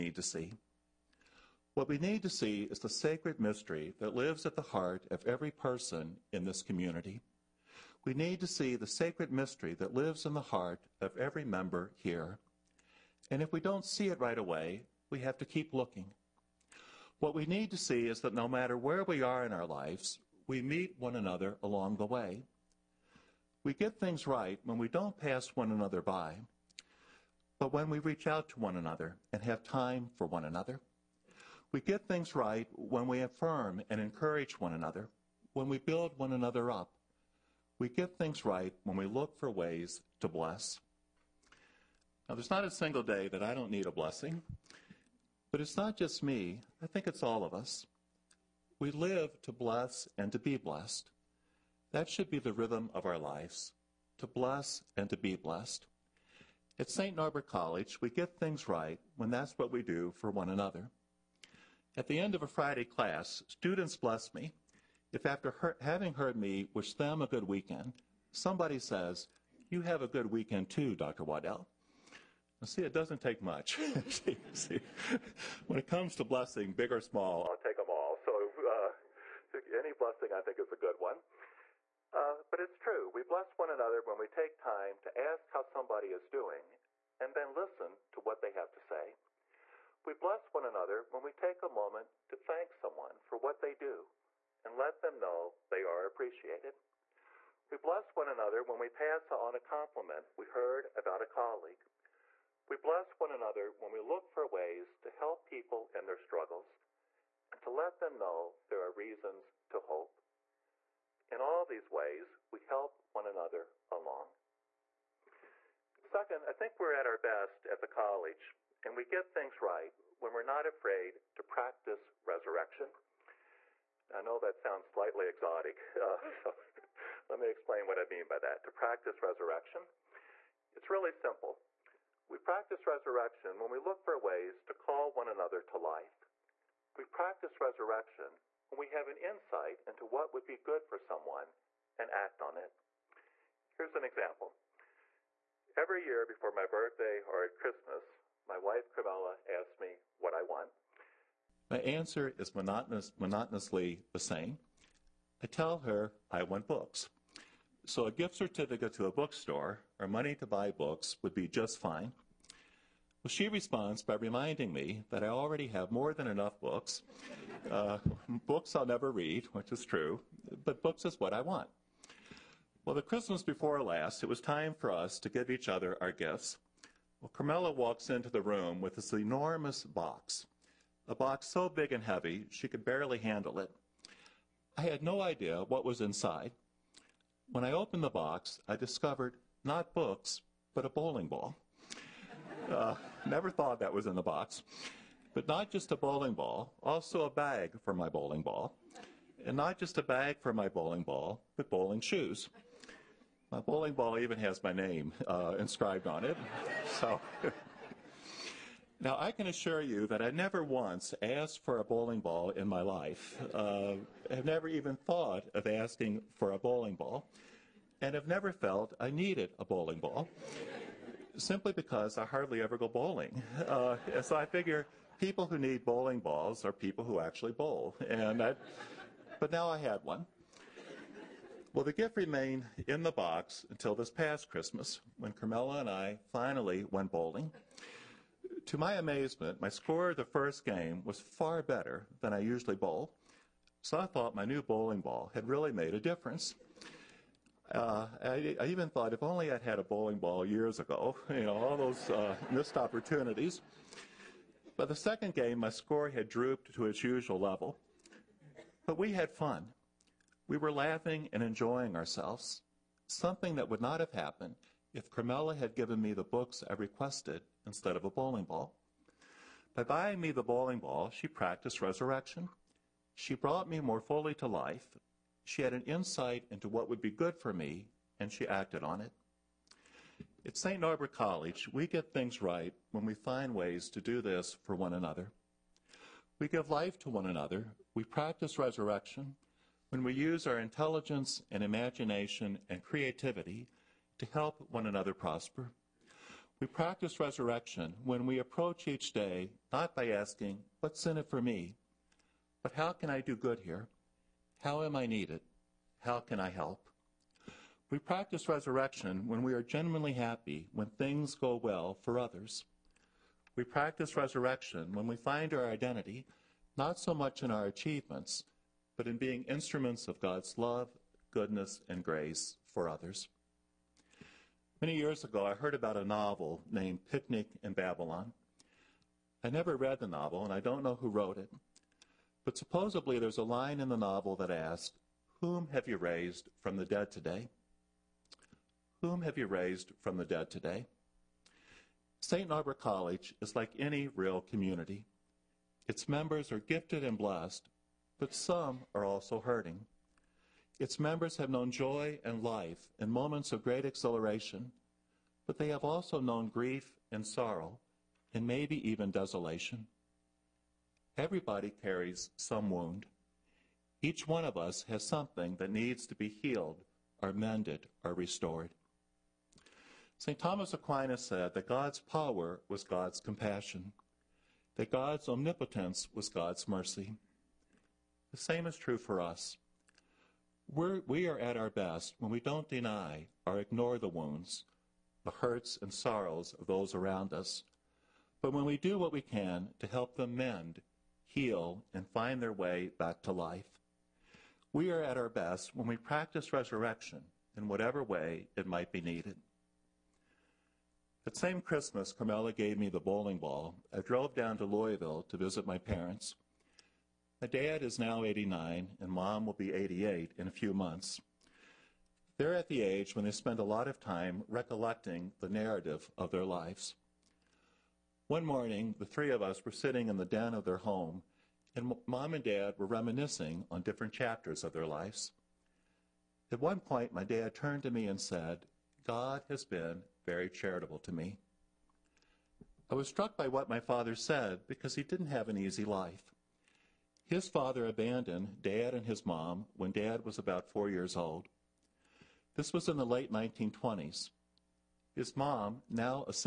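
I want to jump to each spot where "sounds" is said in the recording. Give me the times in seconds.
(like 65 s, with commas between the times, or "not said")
124 s.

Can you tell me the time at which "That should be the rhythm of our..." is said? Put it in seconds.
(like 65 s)
51 s.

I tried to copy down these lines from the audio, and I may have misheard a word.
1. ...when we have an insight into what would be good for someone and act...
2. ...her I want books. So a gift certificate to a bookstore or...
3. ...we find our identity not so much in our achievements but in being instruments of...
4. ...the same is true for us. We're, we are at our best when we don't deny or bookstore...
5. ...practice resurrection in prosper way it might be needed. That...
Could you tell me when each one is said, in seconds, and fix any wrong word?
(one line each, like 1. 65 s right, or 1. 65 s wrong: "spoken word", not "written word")
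1. 138 s right
2. 155 s right
3. 315 s right
4. 378 s wrong: "ignore", not "bookstore"
5. 395 s wrong: "whatever", not "prosper".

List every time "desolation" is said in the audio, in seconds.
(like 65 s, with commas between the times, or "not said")
359 s.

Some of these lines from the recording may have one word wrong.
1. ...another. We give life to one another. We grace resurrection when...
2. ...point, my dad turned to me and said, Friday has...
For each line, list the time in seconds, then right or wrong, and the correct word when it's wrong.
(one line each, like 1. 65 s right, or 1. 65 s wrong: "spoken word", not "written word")
1. 284 s wrong: "practice", not "grace"
2. 426 s wrong: "God", not "Friday".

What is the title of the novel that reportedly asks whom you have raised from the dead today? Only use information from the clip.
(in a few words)
Picnic in Babylon.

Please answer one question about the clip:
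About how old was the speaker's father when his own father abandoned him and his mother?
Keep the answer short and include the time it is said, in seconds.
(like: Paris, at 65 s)
4, at 440 s.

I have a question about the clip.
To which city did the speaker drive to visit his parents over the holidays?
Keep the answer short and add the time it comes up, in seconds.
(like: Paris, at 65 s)
Louisville, at 404 s.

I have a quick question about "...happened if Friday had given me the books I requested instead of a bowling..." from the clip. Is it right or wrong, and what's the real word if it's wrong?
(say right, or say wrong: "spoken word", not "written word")
wrong: "Carmela", not "Friday".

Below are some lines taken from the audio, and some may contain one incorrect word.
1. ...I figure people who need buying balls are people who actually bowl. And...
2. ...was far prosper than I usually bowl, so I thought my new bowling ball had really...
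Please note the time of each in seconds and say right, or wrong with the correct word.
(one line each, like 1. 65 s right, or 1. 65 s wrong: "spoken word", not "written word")
1. 224 s wrong: "bowling", not "buying"
2. 241 s wrong: "better", not "prosper".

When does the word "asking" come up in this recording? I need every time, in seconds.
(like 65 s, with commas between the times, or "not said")
215 s, 300 s.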